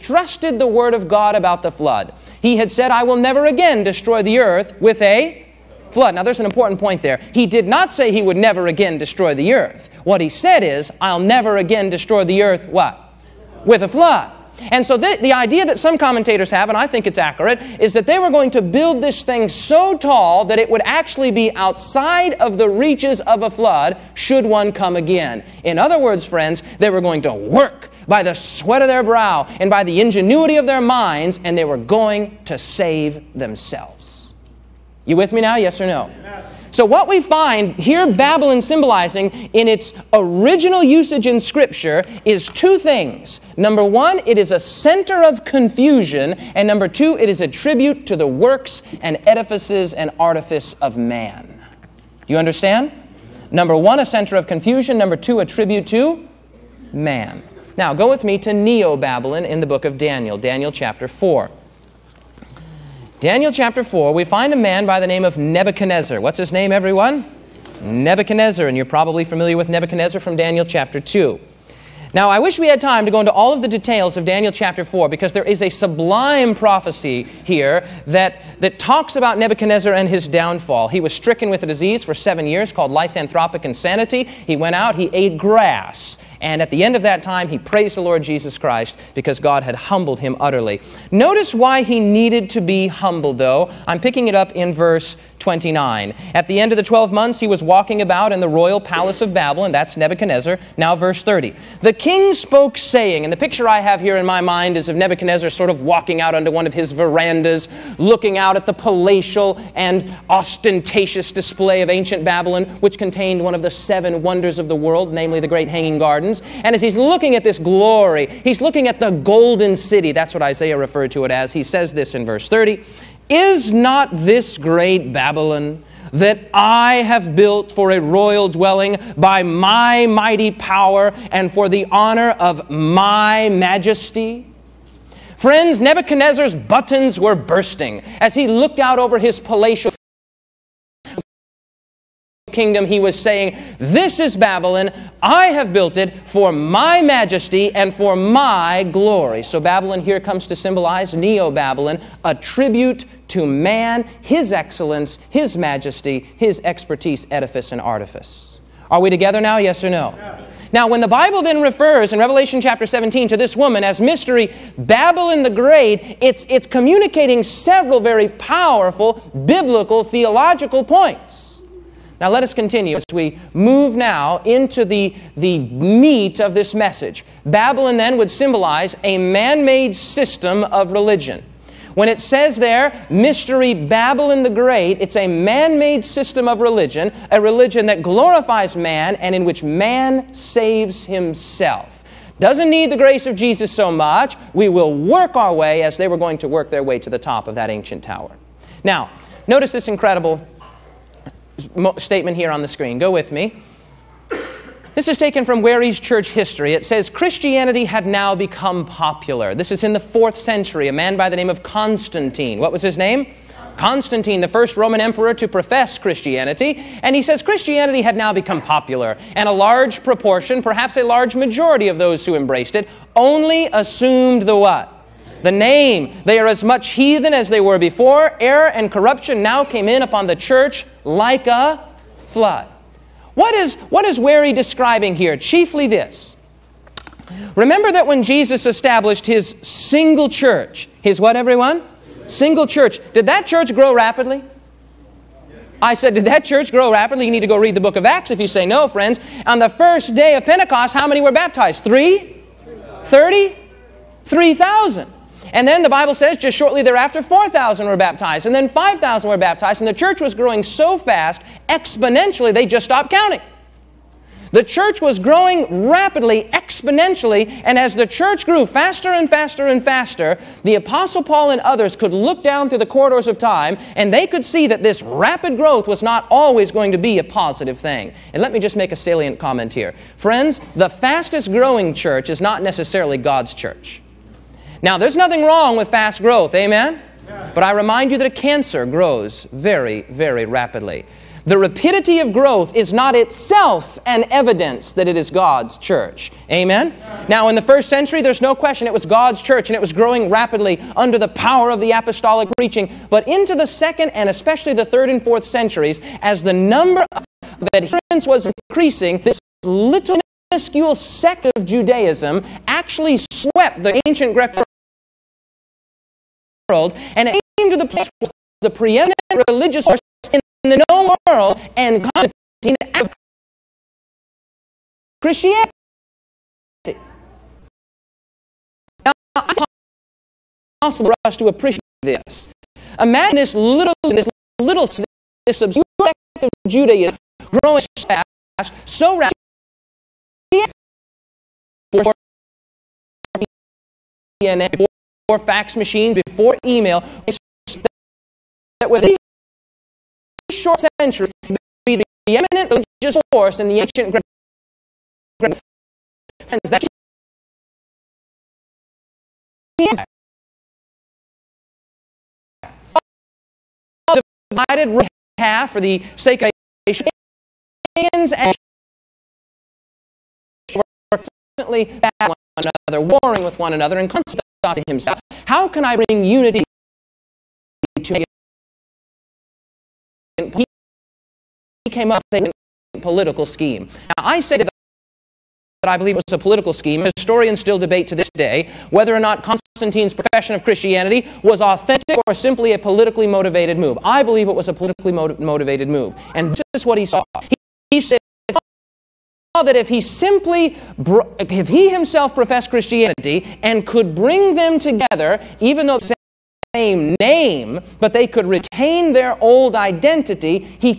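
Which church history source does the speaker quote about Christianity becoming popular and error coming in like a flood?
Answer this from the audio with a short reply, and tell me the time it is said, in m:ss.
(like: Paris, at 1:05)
Wharey's church history, at 3:25.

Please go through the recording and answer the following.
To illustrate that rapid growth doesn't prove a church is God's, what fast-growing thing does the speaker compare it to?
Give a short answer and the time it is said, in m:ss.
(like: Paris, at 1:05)
A cancer, at 4:48.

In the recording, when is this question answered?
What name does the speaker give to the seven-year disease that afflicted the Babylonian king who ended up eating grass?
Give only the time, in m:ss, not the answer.
1:22.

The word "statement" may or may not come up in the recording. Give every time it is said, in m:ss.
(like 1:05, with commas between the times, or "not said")
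3:21.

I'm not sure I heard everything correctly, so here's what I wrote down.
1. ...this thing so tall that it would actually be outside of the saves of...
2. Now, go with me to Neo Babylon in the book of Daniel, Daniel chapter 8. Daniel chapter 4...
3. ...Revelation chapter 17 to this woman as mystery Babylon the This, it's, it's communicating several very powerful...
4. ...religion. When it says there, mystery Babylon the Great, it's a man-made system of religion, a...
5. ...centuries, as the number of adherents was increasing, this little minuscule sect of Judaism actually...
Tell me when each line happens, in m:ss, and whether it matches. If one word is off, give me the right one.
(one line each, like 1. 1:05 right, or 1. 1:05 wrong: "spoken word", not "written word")
1. 0:19 wrong: "reaches", not "saves"
2. 0:57 wrong: "4", not "8"
3. 2:42 wrong: "Great", not "This"
4. 3:00 right
5. 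5:05 right.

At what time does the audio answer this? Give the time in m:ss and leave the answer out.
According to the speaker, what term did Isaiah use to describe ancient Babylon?
1:58.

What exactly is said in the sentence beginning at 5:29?
Now, it's possible for us to appreciate this.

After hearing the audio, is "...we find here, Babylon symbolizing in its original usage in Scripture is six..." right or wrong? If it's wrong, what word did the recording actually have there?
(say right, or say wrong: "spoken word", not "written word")
wrong: "two", not "six".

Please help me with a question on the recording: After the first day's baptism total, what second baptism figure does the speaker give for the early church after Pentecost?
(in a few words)
4,000.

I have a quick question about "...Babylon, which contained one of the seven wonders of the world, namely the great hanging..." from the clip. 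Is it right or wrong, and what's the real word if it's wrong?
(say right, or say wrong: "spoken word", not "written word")
right.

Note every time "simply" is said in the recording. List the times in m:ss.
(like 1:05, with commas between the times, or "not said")
6:32, 6:40.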